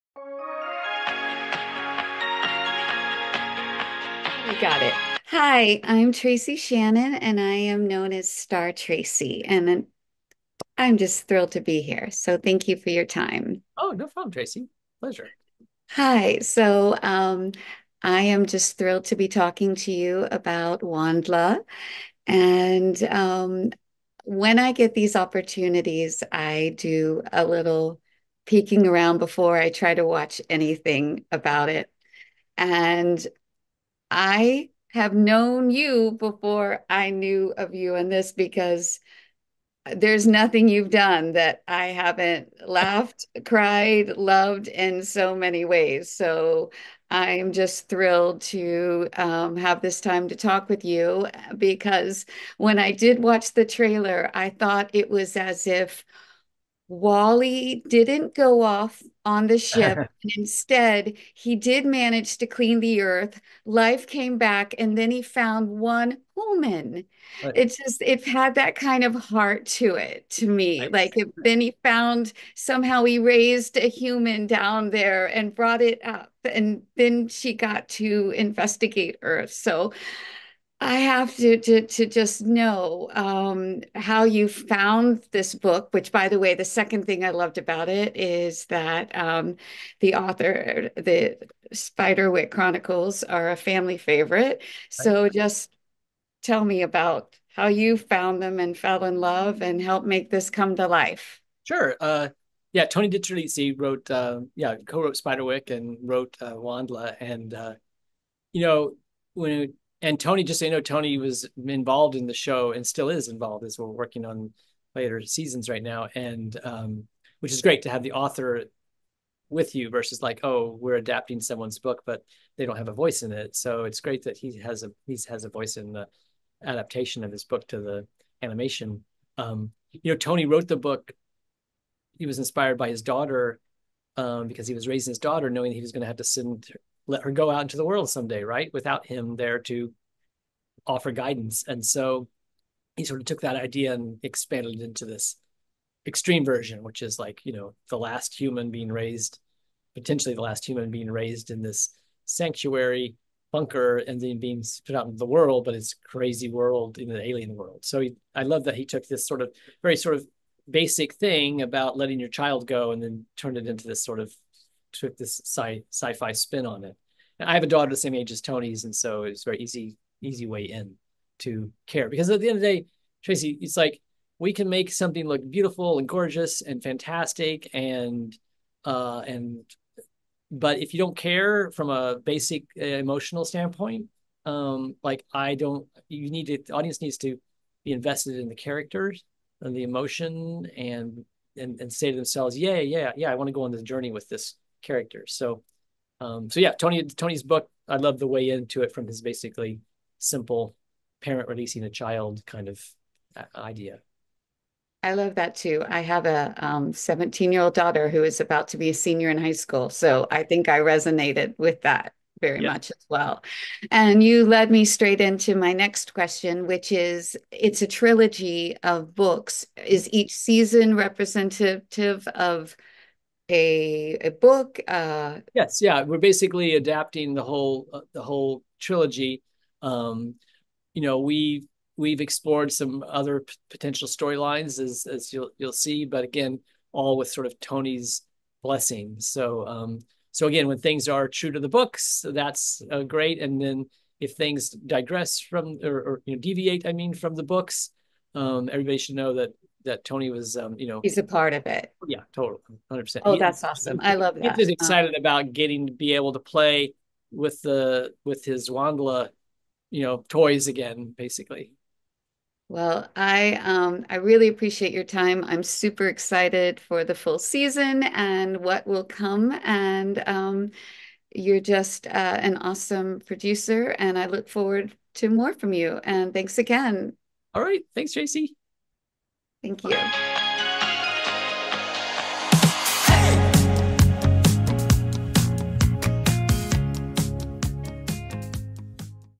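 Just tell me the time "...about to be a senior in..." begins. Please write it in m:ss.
3:28.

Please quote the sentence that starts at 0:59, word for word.
and instead, he did manage to clean the earth.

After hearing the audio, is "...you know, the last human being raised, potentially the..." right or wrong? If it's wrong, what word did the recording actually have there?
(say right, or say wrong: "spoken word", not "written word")
right.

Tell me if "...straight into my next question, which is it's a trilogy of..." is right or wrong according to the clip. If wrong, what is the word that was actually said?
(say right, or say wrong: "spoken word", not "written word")
right.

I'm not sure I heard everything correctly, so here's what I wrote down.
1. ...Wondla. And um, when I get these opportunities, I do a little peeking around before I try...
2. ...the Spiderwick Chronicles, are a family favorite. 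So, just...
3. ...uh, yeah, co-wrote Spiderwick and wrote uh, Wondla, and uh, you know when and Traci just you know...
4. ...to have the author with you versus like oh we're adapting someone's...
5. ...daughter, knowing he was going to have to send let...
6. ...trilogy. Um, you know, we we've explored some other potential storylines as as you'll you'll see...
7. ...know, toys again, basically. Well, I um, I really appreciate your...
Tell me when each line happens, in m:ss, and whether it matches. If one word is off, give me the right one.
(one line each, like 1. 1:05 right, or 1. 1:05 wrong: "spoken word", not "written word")
1. 0:20 right
2. 1:30 right
3. 1:44 wrong: "Tony", not "Traci"
4. 1:57 right
5. 2:15 right
6. 3:48 right
7. 4:20 right.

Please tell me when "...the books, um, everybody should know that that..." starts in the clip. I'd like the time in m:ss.
4:07.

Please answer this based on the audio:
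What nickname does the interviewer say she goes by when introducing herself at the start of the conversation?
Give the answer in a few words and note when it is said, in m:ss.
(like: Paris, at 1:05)
Star Traci, at 0:08.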